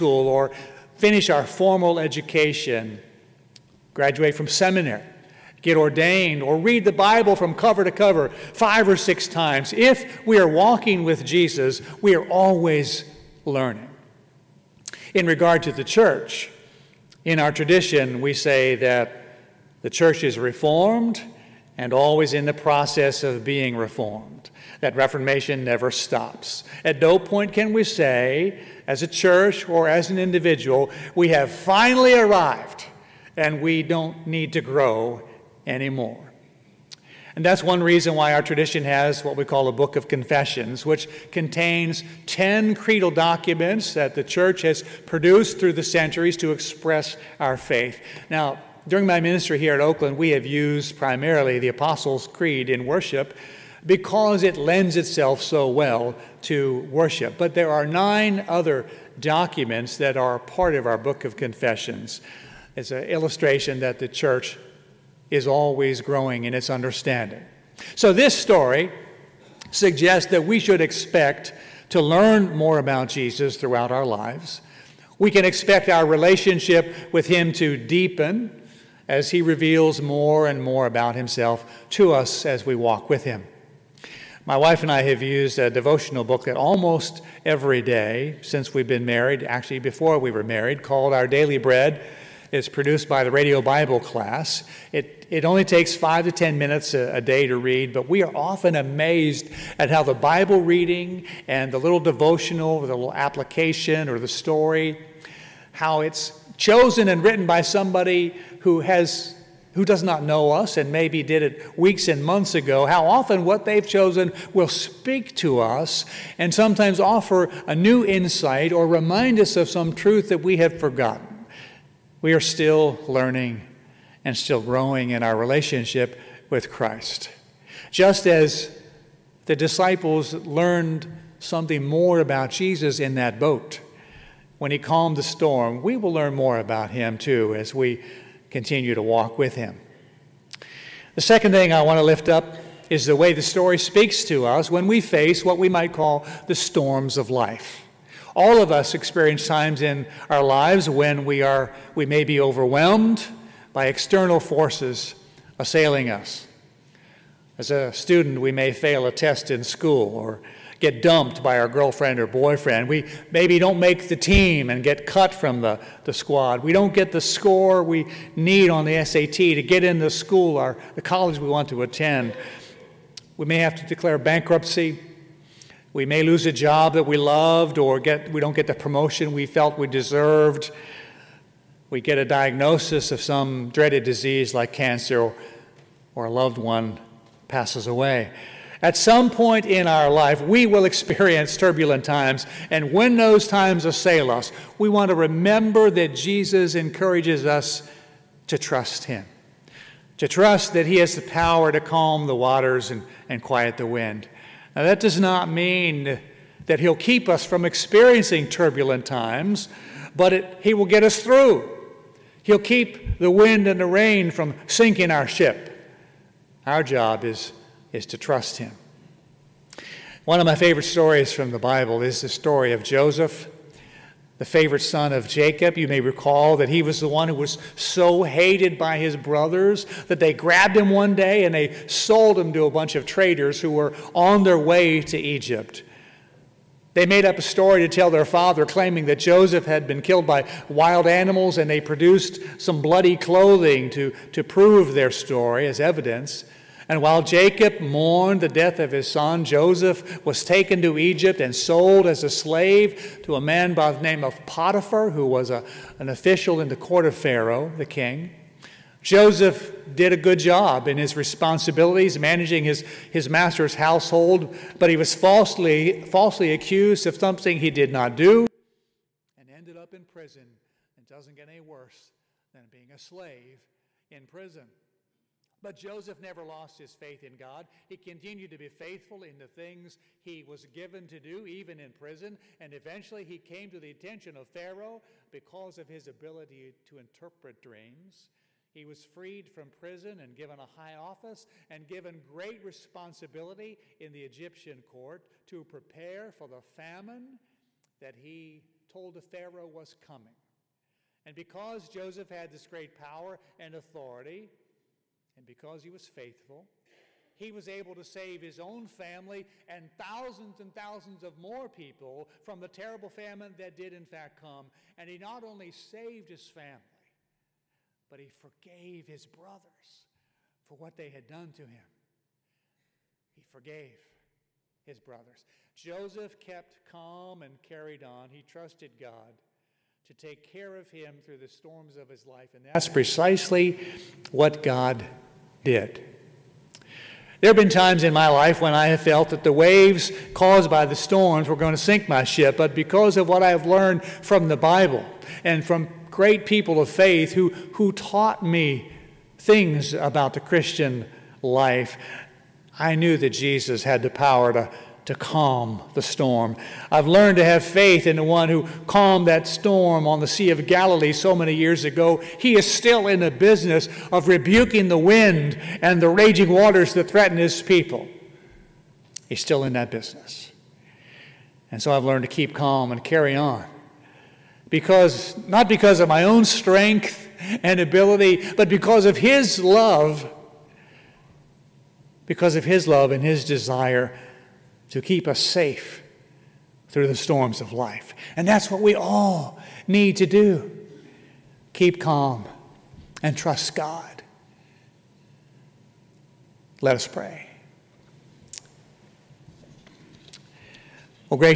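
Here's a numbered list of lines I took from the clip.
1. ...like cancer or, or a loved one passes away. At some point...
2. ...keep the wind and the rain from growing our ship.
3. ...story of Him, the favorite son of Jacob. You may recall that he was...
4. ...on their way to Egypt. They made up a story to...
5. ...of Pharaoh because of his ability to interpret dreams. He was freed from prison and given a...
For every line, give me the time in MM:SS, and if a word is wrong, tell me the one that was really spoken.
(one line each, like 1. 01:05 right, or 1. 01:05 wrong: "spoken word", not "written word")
1. 03:04 right
2. 03:32 wrong: "sinking", not "growing"
3. 03:42 wrong: "Joseph", not "Him"
4. 03:54 right
5. 04:44 right.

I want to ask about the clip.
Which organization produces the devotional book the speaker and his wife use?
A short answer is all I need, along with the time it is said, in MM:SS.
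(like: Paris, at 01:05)
Radio Bible class, at 01:33.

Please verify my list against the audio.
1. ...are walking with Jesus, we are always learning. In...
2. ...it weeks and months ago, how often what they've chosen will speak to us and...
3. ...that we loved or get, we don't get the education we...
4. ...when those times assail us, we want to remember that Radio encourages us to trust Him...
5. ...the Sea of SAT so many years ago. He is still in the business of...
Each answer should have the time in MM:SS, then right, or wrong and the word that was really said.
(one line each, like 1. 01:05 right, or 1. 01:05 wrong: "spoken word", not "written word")
1. 00:10 right
2. 01:51 right
3. 02:56 wrong: "promotion", not "education"
4. 03:12 wrong: "Jesus", not "Radio"
5. 06:00 wrong: "Galilee", not "SAT".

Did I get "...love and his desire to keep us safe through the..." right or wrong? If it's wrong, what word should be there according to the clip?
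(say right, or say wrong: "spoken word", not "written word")
right.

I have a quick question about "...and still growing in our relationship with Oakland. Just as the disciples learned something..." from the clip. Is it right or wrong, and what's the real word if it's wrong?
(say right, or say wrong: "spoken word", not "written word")
wrong: "Christ", not "Oakland".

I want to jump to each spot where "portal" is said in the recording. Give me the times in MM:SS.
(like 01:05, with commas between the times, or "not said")
not said.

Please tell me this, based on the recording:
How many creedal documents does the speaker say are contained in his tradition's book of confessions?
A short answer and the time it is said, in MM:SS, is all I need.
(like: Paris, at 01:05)
10, at 00:42.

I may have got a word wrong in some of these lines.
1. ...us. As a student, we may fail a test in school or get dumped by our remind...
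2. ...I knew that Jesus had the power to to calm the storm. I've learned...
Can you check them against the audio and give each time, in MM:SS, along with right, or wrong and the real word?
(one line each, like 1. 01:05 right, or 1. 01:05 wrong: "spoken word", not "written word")
1. 02:36 wrong: "girlfriend", not "remind"
2. 05:52 right.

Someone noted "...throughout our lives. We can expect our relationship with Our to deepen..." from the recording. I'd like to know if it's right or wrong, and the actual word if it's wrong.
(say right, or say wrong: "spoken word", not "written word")
wrong: "Him", not "Our".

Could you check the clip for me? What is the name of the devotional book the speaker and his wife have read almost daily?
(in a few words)
Our Daily Bread.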